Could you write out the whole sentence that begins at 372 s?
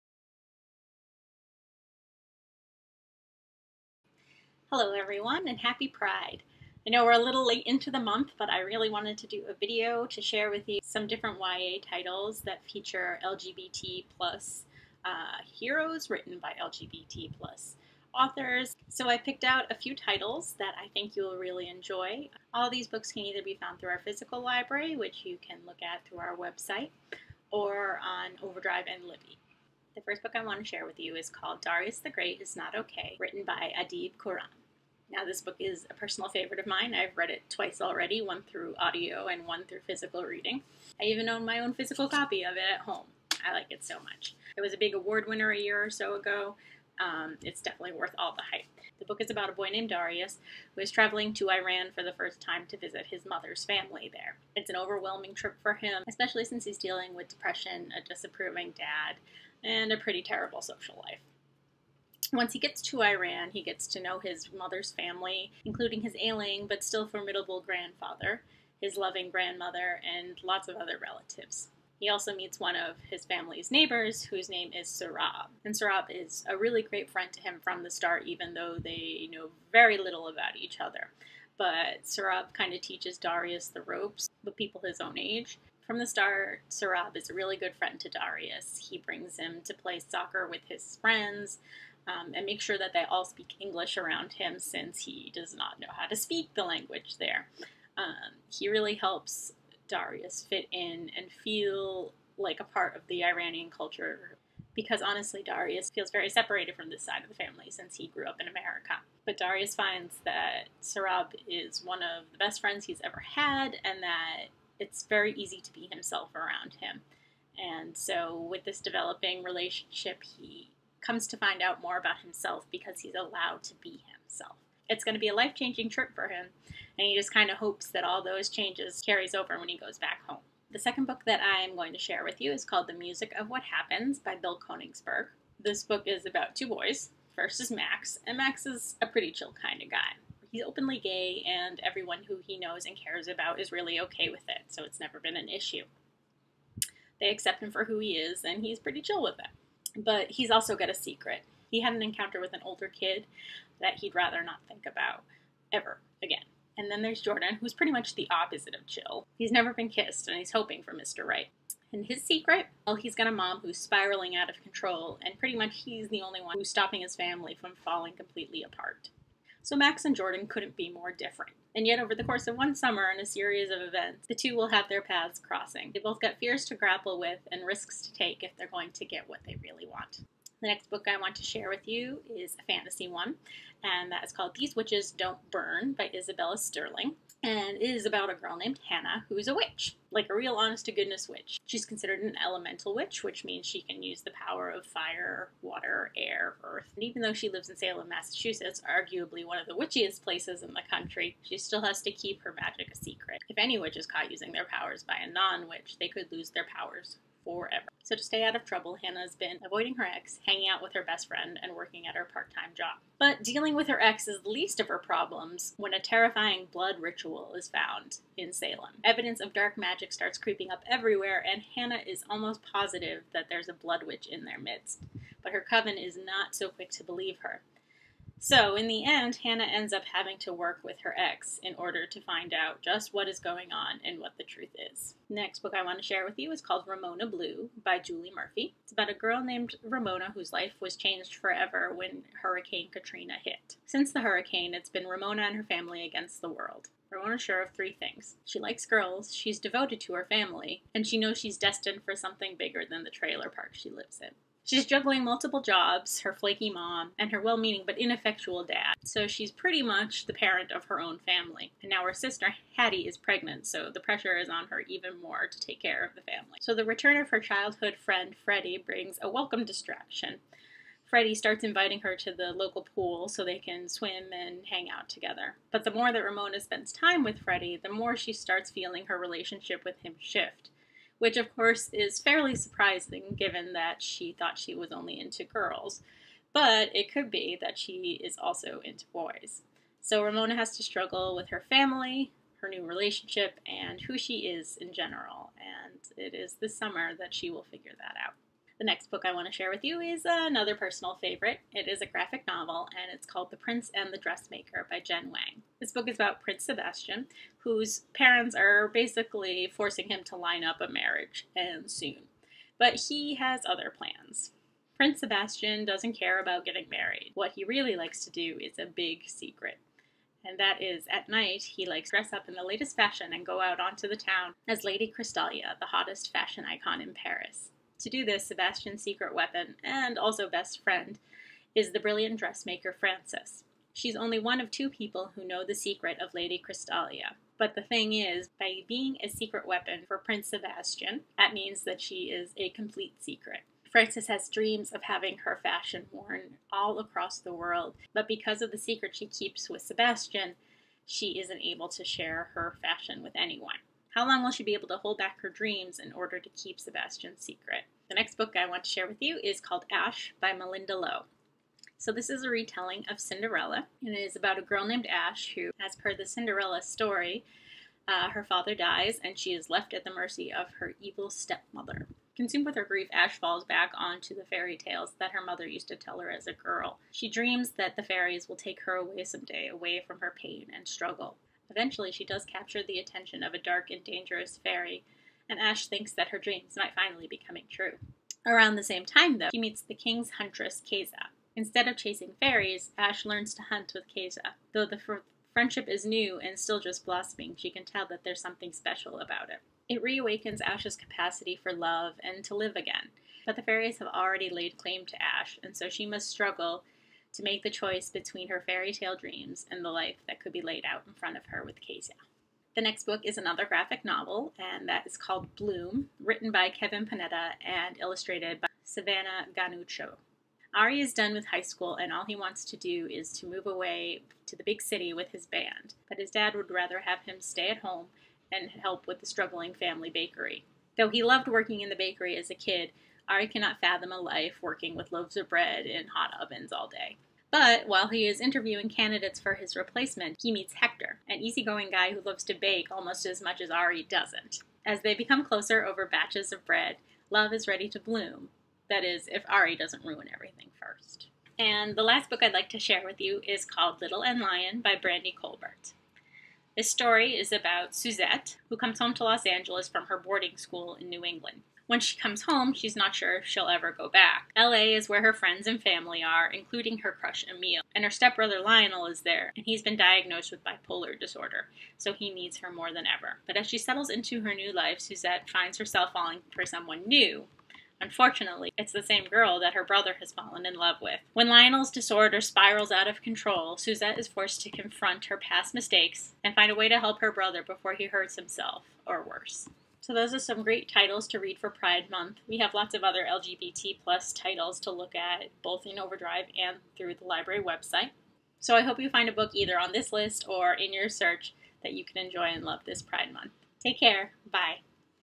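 Consumed with her grief, Ash falls back onto the fairy tales that her mother used to tell her as a girl.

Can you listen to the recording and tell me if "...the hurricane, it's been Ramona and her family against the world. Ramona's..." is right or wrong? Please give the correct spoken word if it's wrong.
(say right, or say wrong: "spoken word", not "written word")
right.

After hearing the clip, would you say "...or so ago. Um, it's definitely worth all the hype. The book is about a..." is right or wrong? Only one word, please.
right.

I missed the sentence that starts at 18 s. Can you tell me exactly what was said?
So I picked out a few titles that I think you'll really enjoy.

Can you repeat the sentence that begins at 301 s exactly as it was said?
It is a graphic novel and it's called The Prince and the Dressmaker by Jen Wang.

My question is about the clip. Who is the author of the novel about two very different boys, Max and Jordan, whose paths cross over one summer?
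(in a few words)
Bill Konigsberg.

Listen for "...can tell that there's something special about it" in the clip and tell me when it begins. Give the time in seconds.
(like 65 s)
397 s.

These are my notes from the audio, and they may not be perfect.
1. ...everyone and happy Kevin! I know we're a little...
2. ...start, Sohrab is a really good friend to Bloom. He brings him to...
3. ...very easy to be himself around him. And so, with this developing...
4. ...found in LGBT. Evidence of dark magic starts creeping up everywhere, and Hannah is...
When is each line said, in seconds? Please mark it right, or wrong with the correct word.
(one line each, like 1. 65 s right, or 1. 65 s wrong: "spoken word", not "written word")
1. 4 s wrong: "Pride", not "Kevin"
2. 86 s wrong: "Darius", not "Bloom"
3. 115 s right
4. 217 s wrong: "Salem", not "LGBT".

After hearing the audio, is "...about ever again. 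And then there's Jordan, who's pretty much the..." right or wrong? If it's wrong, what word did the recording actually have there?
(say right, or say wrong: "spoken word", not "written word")
right.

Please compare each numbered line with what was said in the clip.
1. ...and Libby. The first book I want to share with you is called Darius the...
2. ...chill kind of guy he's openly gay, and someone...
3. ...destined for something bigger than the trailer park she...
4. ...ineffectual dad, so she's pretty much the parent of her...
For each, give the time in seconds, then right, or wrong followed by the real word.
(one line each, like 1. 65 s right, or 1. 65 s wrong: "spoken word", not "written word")
1. 28 s right
2. 139 s wrong: "everyone", not "someone"
3. 251 s right
4. 257 s right.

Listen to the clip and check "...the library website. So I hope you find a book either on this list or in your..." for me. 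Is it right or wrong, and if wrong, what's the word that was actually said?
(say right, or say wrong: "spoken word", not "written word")
right.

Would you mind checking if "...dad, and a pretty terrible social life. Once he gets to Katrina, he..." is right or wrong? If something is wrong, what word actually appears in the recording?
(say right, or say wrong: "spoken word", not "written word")
wrong: "Iran", not "Katrina".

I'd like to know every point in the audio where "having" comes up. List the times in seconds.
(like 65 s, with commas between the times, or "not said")
230 s, 345 s.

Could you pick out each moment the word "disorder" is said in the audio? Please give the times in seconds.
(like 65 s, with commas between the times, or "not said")
471 s, 481 s.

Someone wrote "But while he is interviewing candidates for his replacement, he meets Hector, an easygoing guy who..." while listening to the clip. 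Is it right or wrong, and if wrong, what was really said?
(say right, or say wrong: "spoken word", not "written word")
right.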